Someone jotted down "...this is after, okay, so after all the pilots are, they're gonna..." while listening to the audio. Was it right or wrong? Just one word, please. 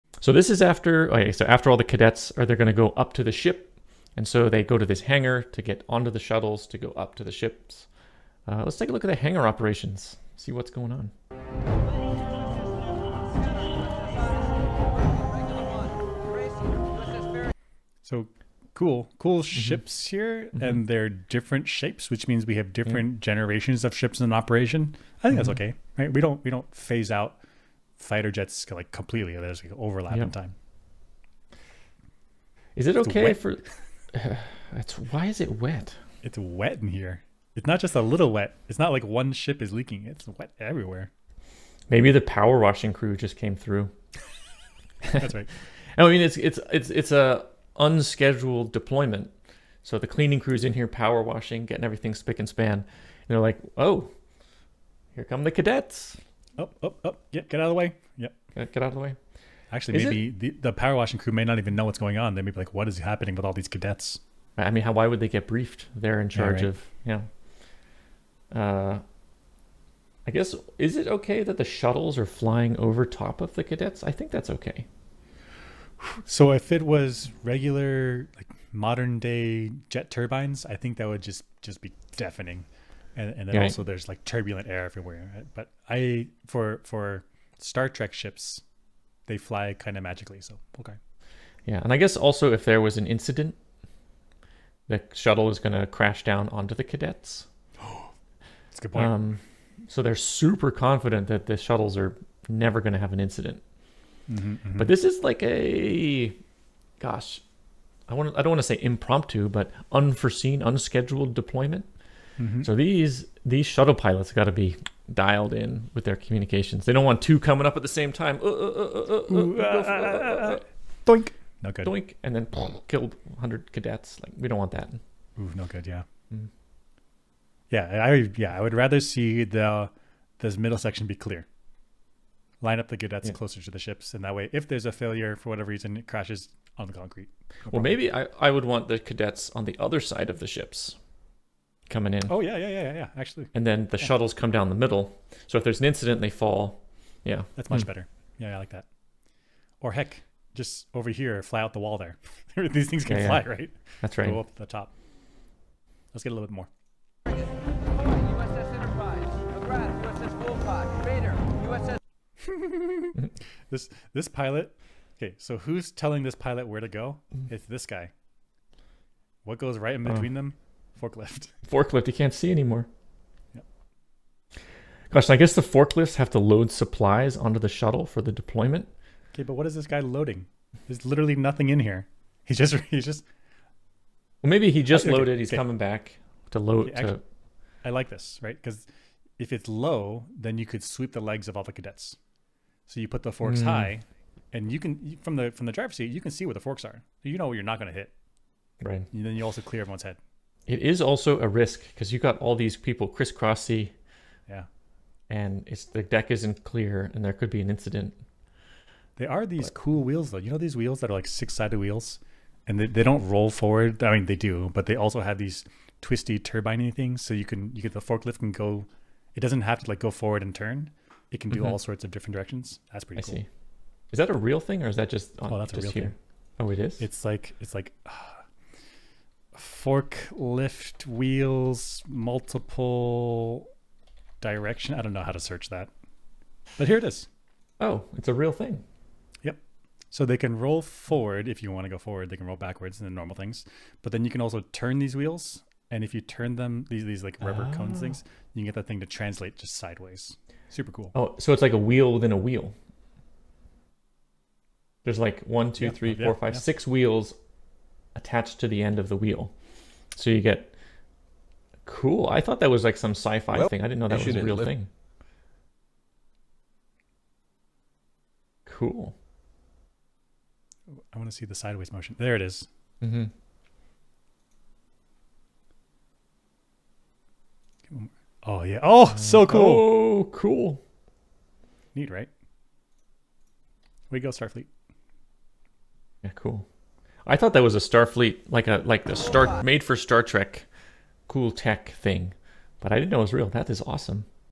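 wrong.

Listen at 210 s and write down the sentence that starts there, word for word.
You know these wheels that are like six-sided wheels, and they, they don't roll forward.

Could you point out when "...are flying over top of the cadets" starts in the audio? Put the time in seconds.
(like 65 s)
72 s.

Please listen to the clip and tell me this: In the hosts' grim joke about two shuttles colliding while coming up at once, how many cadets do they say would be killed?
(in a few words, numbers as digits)
100.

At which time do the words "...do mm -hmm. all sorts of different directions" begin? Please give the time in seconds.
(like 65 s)
221 s.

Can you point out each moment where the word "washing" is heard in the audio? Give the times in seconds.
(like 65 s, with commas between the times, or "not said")
42 s, 51 s, 60 s.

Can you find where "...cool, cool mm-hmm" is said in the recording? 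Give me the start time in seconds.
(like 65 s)
18 s.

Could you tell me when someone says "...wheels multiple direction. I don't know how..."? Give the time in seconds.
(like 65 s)
231 s.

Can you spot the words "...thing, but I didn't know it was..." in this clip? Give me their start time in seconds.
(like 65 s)
291 s.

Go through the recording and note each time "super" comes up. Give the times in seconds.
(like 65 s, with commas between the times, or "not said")
100 s, 250 s.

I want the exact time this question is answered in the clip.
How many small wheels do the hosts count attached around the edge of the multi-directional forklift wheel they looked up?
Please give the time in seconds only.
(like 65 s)
256 s.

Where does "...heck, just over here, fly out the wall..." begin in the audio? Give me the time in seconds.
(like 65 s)
149 s.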